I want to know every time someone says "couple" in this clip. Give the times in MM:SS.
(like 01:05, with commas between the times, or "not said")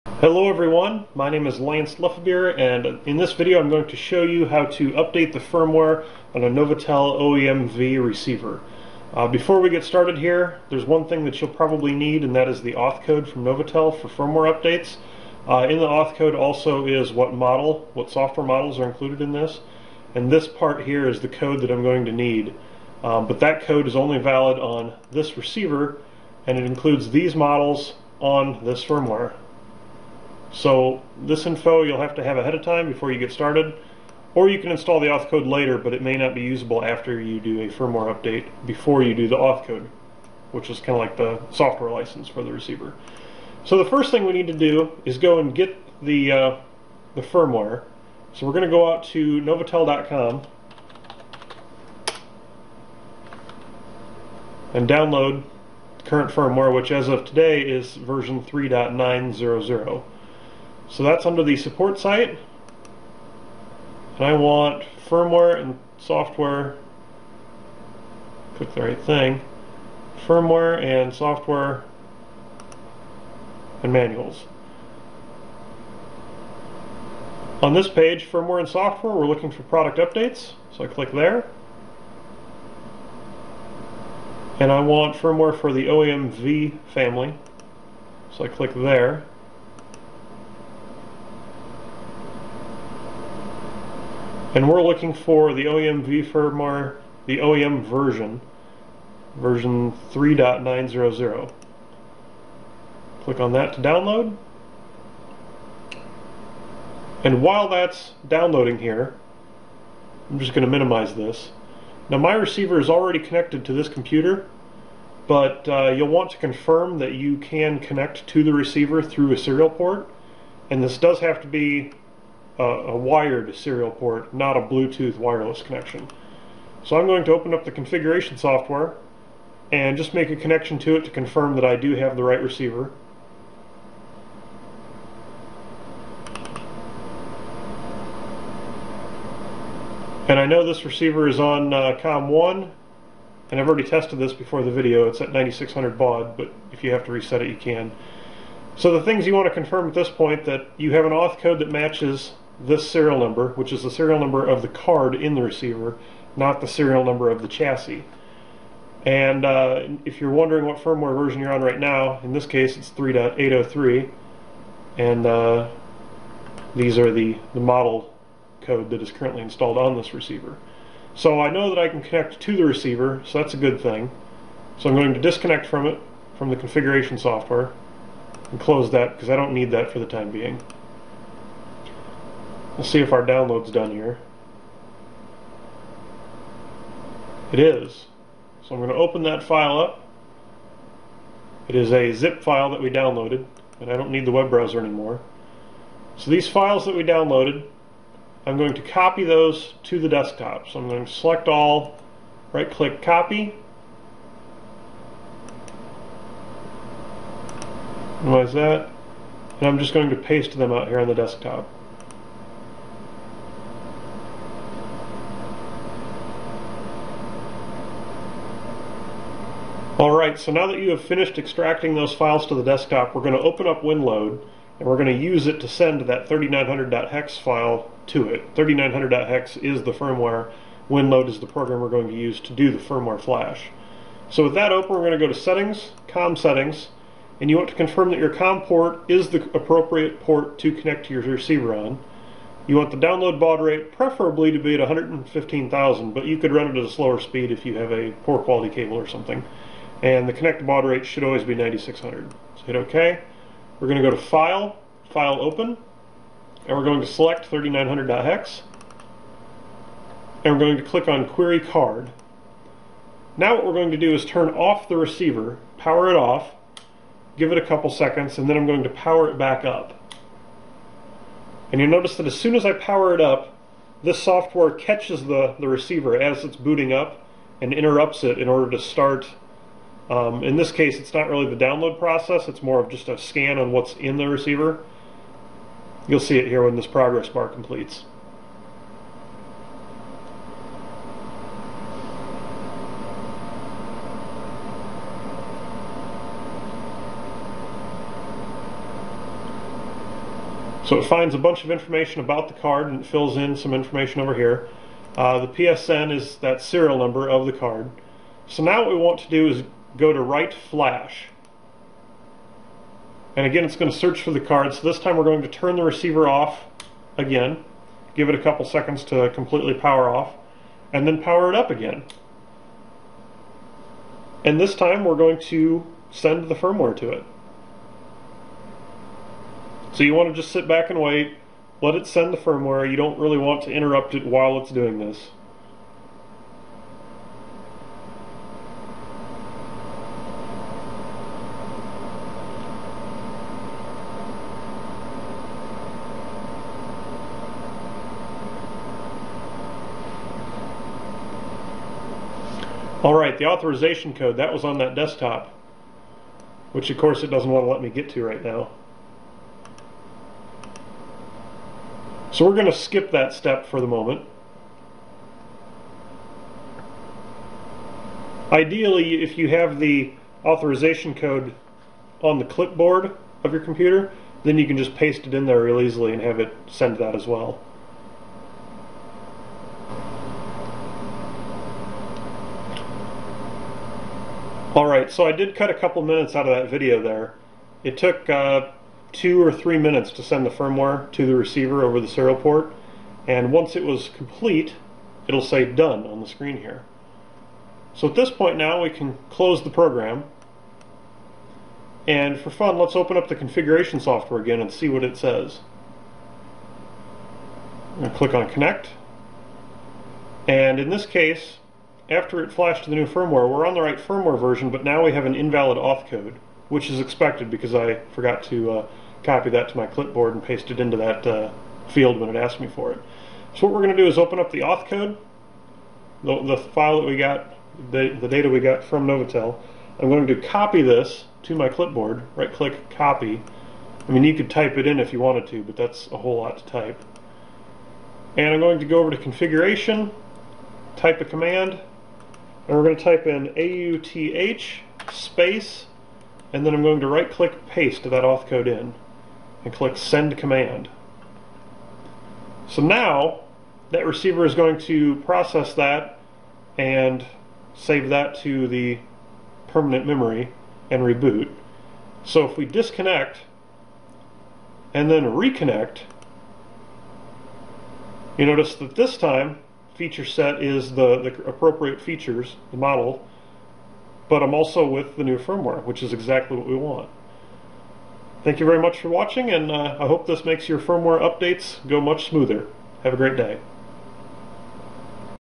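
04:27, 05:18, 06:25.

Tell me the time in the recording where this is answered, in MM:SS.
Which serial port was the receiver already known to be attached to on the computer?
02:22.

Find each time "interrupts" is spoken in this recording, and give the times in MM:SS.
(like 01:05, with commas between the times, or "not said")
04:37, 05:33.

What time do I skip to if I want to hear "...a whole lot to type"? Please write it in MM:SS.
07:16.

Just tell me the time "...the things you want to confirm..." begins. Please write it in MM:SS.
02:28.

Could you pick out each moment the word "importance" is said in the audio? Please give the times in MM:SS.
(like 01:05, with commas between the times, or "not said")
not said.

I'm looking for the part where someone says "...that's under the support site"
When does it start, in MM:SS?
01:01.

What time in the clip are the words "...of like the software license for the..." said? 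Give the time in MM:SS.
00:40.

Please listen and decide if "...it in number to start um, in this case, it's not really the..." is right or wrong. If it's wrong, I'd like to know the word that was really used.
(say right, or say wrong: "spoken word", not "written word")
wrong: "order", not "number".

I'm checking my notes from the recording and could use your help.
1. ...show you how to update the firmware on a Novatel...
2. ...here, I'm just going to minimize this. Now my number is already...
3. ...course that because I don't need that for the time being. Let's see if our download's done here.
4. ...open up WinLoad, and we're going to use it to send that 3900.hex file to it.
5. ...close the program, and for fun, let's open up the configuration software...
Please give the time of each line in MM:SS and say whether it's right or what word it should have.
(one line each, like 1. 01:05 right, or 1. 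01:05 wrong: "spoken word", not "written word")
1. 00:03 right
2. 01:48 wrong: "receiver", not "number"
3. 02:58 wrong: "close", not "course"
4. 03:43 right
5. 06:39 right.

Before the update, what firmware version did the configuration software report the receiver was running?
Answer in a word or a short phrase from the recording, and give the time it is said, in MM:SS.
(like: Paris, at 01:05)
3.803, at 02:42.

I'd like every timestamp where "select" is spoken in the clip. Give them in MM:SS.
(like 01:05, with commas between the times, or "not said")
03:21, 04:17.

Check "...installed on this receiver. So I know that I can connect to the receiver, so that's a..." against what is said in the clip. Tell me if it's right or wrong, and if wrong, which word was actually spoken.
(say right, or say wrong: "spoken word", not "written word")
right.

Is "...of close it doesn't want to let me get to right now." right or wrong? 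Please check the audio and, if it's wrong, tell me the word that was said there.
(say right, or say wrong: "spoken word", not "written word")
wrong: "course", not "close".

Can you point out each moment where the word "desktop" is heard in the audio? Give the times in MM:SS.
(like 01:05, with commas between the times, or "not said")
03:20, 03:31, 03:42, 05:54.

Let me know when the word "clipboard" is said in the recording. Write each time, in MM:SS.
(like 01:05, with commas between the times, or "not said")
06:12, 06:59, 07:11.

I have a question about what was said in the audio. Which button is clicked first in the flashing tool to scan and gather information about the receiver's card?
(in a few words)
Query Card.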